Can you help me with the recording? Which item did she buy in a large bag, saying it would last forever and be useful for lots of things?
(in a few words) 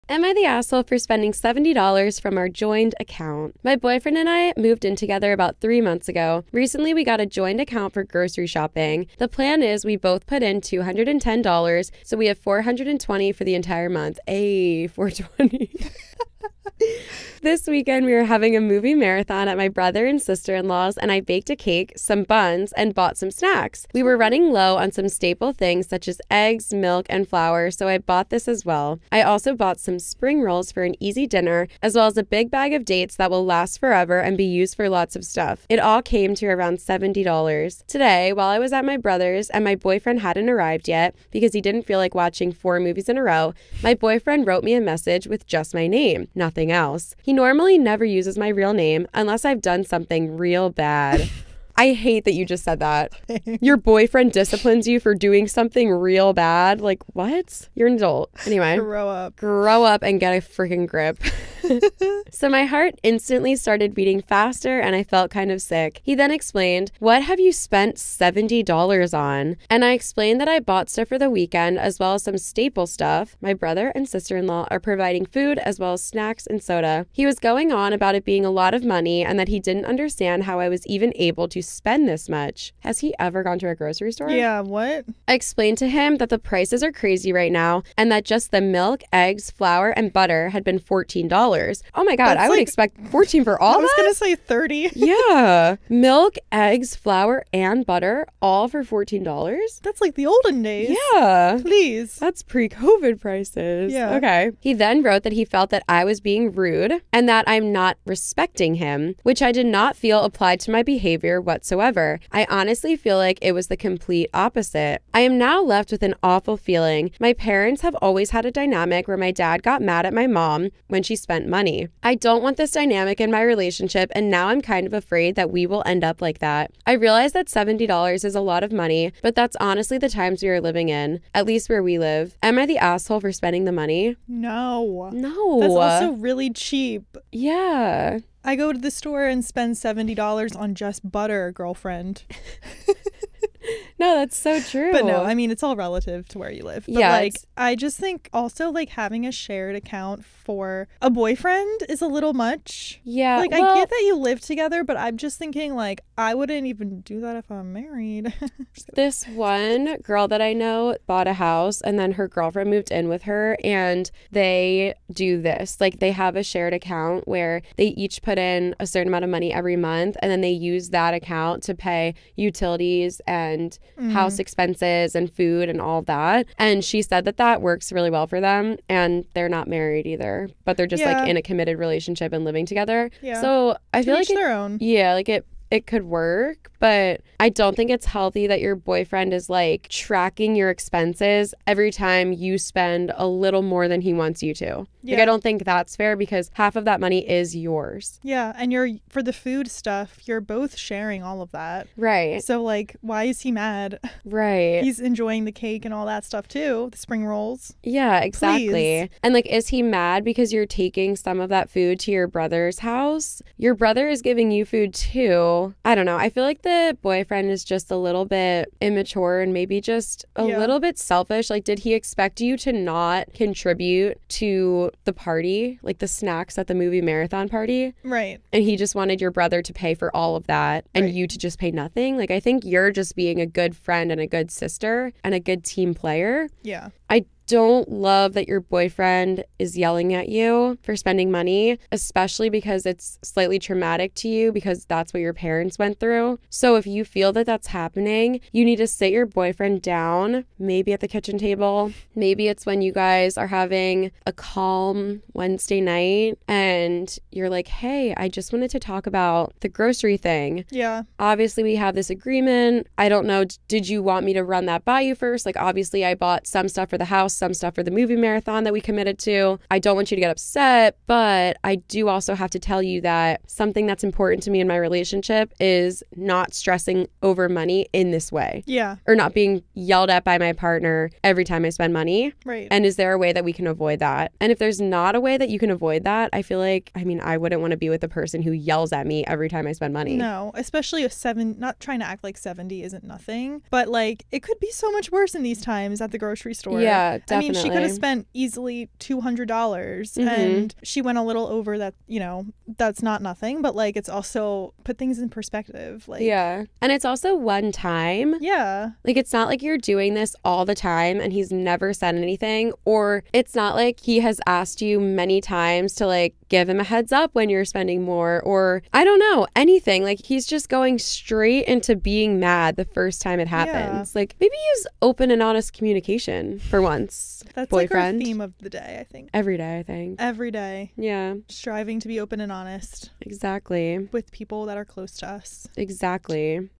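dates.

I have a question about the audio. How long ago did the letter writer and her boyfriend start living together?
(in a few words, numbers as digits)
3 months.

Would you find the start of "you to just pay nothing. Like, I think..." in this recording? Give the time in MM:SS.
03:51.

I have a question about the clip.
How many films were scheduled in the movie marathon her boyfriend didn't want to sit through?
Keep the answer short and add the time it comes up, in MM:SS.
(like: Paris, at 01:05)
4, at 00:42.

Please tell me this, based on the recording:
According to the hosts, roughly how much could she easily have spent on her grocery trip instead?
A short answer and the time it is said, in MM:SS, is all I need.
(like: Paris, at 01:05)
$200, at 04:58.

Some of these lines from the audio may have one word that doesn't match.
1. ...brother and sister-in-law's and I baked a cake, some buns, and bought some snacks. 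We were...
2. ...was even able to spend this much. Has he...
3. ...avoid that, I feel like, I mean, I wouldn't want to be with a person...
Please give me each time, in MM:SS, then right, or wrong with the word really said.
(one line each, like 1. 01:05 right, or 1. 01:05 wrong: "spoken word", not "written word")
1. 00:19 right
2. 01:20 right
3. 04:45 right.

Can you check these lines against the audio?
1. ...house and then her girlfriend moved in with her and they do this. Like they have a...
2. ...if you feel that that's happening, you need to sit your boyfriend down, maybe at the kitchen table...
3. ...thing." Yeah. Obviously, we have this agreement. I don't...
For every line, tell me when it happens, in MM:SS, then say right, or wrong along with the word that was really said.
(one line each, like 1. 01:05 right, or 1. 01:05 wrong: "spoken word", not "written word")
1. 02:41 right
2. 04:06 right
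3. 04:20 right.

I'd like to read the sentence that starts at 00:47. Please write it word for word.
He normally never uses my real name unless I've done something real bad.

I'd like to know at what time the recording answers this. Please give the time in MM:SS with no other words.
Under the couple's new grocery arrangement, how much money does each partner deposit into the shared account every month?
00:10.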